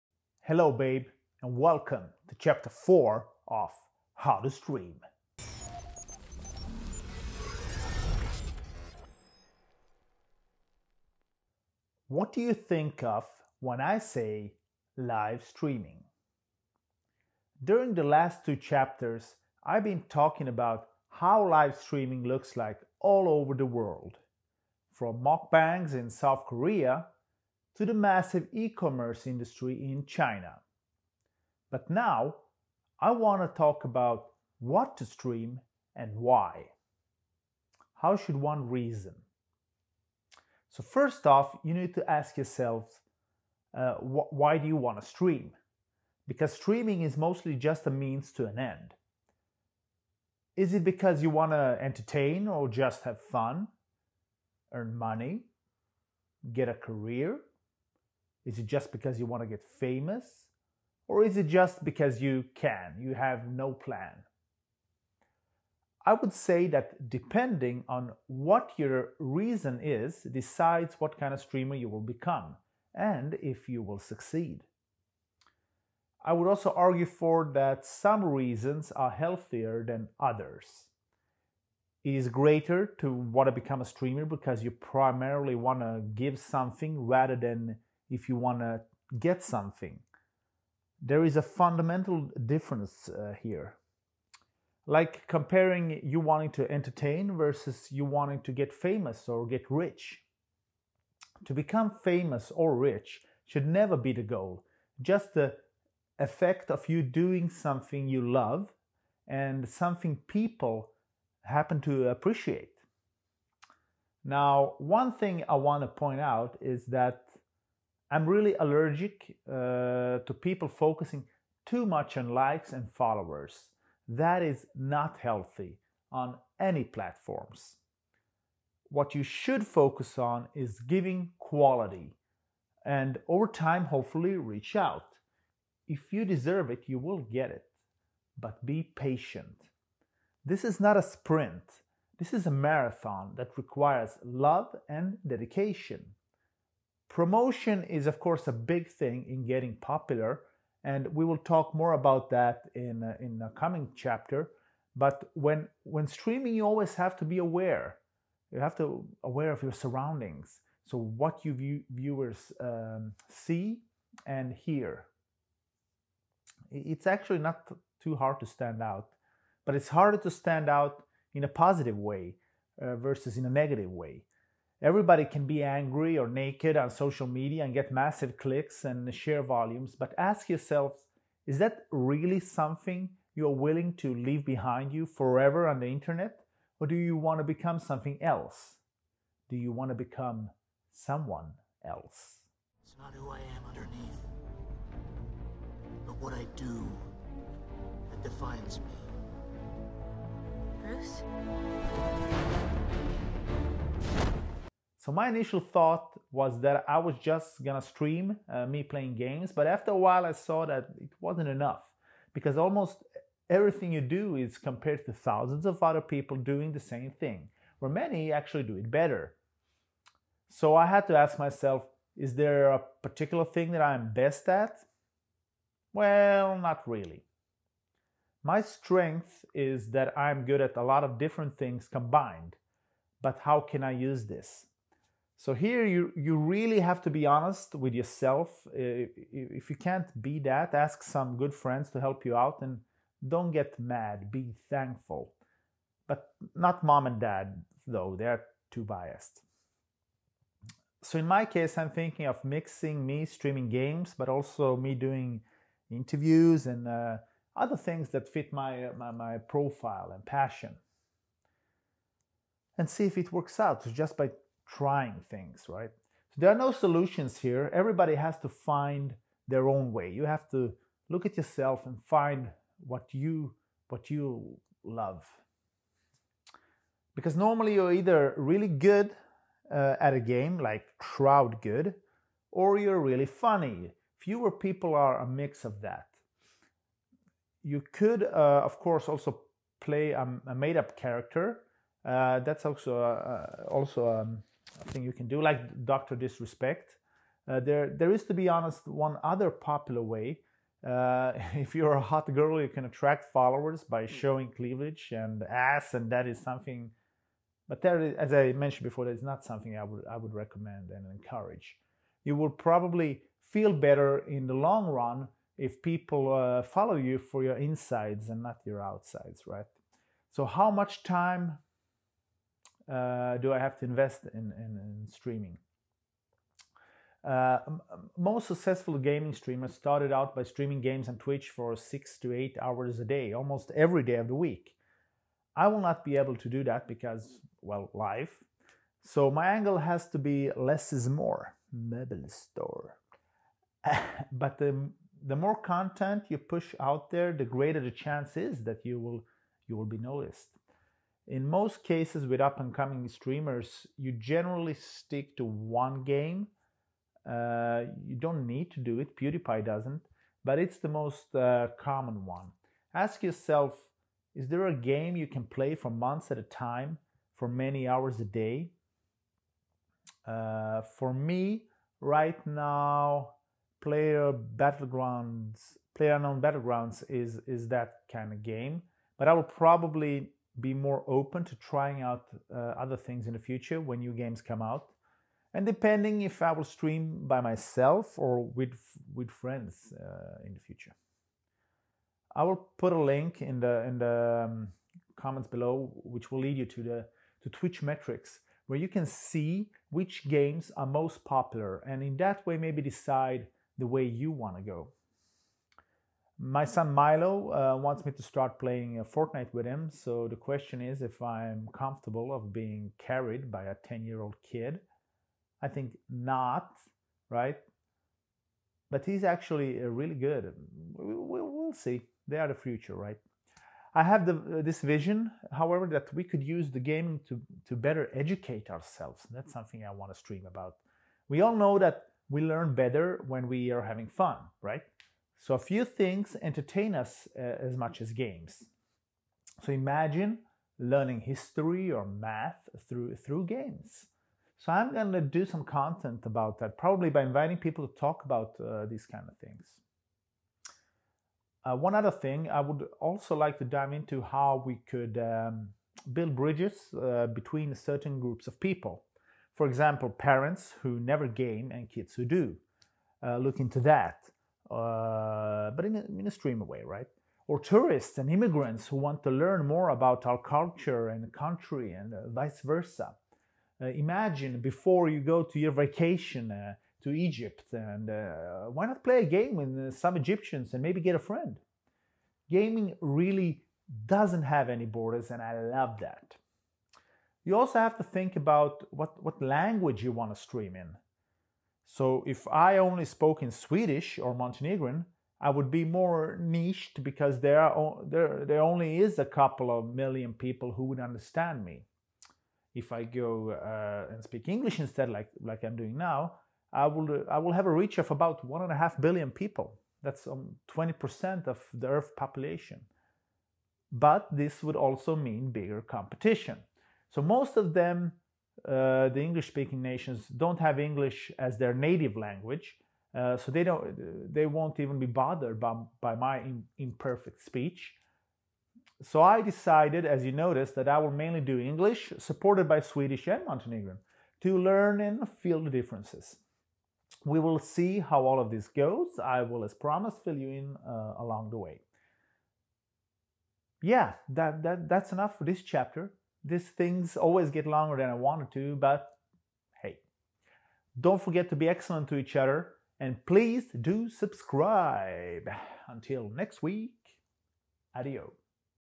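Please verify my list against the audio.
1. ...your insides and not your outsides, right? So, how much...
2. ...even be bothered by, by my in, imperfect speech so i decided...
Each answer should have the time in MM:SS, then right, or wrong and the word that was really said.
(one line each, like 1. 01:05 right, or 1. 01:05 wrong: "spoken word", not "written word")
1. 05:17 right
2. 08:44 right.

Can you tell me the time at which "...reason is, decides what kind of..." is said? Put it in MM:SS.
01:09.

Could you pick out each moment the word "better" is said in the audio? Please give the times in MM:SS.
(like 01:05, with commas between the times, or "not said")
03:38, 05:13, 07:07, 07:12.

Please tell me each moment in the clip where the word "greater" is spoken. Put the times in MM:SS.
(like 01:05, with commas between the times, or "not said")
01:22, 05:47.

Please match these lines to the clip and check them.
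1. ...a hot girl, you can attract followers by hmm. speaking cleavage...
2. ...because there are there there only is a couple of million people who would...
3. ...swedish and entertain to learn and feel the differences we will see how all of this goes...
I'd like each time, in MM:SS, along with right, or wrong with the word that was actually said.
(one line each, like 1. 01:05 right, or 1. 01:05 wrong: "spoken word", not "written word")
1. 05:01 wrong: "showing", not "speaking"
2. 08:17 right
3. 08:52 wrong: "montenegrin", not "entertain".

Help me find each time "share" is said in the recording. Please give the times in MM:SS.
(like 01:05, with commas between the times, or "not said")
02:59.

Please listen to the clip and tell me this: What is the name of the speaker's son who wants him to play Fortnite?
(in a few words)
Milo.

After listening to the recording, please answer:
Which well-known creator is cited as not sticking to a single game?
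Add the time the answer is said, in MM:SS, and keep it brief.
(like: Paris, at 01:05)
PewDiePie, at 05:59.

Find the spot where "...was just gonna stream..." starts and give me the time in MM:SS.
03:26.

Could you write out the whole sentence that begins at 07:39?
For example, parents who never game and kids who do.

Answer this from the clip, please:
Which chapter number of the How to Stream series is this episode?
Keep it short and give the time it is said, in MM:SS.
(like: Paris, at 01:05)
4, at 00:02.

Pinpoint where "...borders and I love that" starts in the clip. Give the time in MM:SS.
08:04.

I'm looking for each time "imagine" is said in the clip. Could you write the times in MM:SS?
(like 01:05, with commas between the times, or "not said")
07:19, 07:53.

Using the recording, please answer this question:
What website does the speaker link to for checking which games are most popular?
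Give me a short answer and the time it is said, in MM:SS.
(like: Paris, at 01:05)
TwitchMetrics, at 06:37.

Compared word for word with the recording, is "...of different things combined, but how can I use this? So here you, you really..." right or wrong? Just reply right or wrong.
right.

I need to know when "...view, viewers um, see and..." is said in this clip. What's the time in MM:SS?
02:41.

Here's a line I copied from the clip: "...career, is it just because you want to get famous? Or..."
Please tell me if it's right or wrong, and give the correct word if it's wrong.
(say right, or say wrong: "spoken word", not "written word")
right.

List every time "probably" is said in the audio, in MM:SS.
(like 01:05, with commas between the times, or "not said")
05:12, 06:19, 07:26.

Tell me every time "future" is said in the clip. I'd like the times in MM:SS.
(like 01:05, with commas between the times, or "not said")
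06:23, 06:30, 07:02.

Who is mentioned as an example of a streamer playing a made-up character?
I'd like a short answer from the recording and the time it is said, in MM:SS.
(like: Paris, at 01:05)
Doctor Disrespect, at 04:55.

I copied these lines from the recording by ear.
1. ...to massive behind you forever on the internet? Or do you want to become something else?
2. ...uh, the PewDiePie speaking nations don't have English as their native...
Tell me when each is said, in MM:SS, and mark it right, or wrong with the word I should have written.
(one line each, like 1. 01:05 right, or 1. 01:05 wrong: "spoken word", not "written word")
1. 03:03 wrong: "leave", not "massive"
2. 08:38 wrong: "English", not "PewDiePie".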